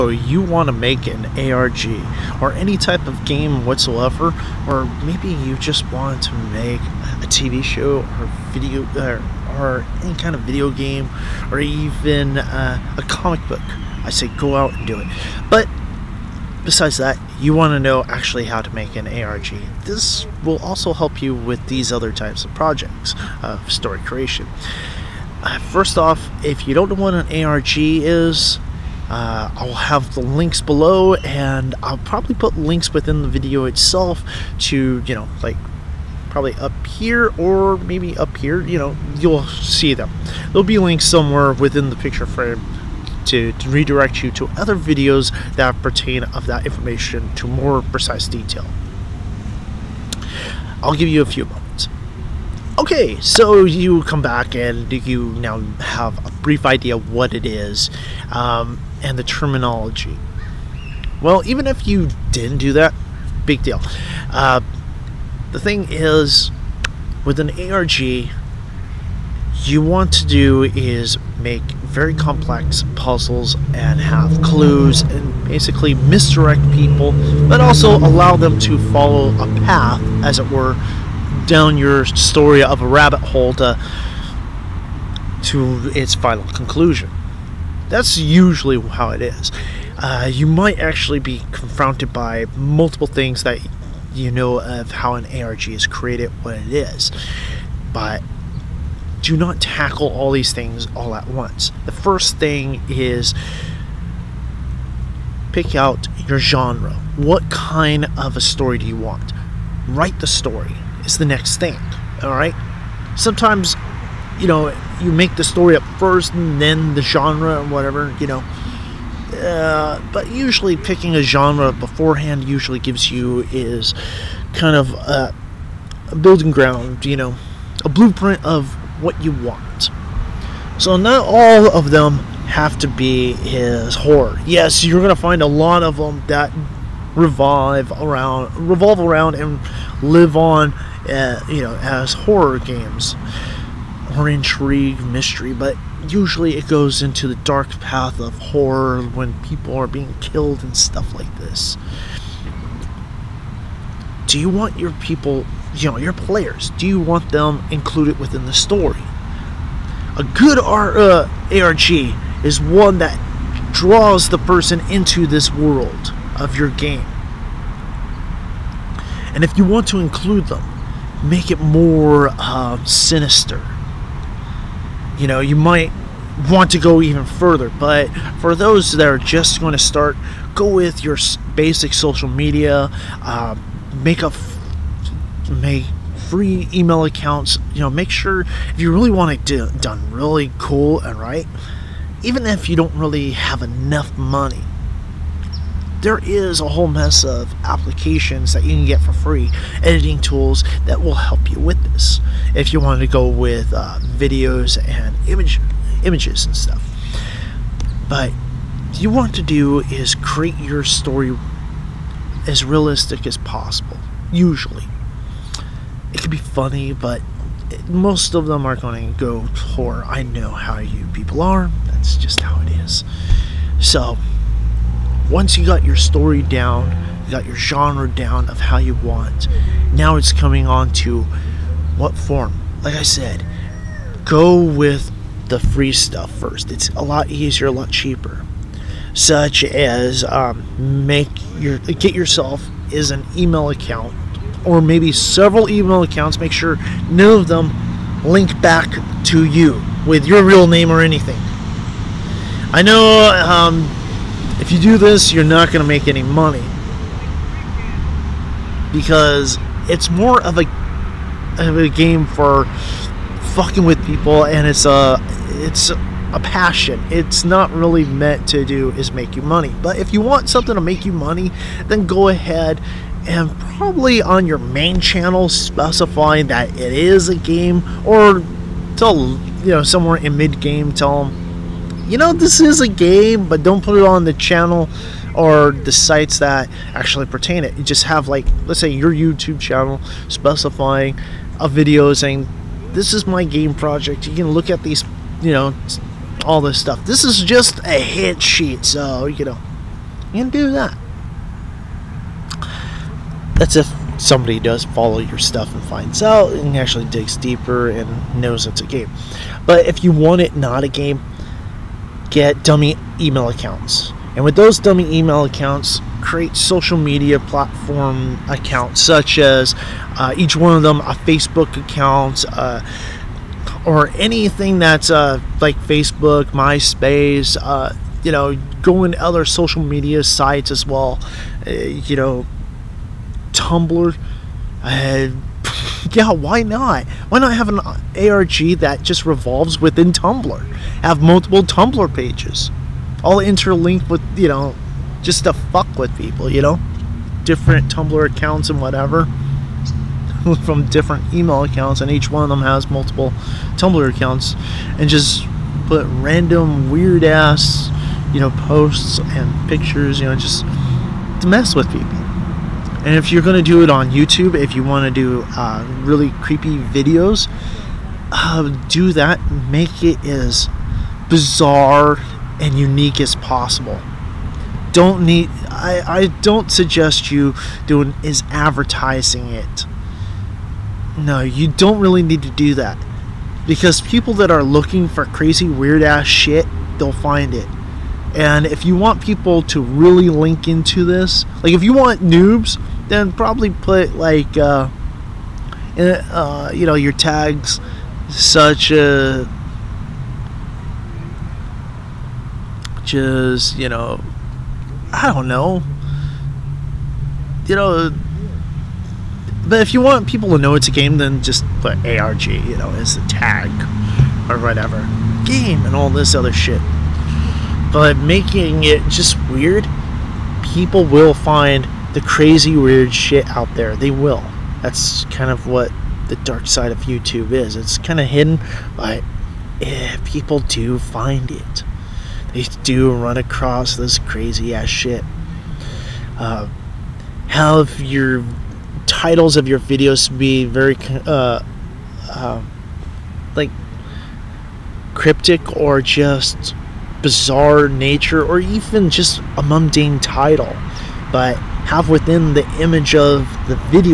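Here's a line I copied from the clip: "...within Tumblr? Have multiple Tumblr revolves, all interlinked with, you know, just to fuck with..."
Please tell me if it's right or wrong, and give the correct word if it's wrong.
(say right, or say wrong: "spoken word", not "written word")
wrong: "pages", not "revolves".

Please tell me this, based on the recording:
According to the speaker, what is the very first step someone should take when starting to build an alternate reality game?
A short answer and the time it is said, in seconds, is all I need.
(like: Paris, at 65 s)
Pick out your genre, at 105 s.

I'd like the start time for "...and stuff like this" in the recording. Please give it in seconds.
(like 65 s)
150 s.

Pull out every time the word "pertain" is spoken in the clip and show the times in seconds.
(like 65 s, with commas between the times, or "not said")
45 s, 287 s.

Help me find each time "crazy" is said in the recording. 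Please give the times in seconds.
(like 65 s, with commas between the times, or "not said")
385 s, 422 s, 434 s.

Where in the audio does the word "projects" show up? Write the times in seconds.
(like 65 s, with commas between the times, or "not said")
22 s, 293 s.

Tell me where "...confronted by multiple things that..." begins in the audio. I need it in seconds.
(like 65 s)
91 s.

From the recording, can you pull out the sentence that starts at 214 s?
Usually, it can be funny, but most of them are going to go for.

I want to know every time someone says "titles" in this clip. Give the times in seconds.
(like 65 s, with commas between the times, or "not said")
439 s, 450 s.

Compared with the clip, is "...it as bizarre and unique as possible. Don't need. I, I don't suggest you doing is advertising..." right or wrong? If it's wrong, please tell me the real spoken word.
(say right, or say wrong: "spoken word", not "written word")
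right.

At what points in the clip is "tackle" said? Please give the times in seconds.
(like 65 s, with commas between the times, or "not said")
99 s.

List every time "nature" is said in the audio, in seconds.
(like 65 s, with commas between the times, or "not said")
447 s.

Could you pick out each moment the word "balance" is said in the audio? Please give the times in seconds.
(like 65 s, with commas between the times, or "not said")
not said.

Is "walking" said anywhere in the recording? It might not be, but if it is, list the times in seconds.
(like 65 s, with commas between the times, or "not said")
not said.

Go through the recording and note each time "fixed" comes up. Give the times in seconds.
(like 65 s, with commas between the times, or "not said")
not said.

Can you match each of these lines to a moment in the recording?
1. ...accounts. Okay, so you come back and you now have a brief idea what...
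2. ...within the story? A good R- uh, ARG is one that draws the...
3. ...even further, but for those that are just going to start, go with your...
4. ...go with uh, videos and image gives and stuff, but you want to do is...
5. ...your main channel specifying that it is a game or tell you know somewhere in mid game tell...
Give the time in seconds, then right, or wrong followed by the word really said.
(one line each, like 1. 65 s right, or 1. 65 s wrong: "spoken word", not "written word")
1. 51 s wrong: "moments", not "accounts"
2. 158 s right
3. 177 s right
4. 203 s wrong: "images", not "gives"
5. 274 s right.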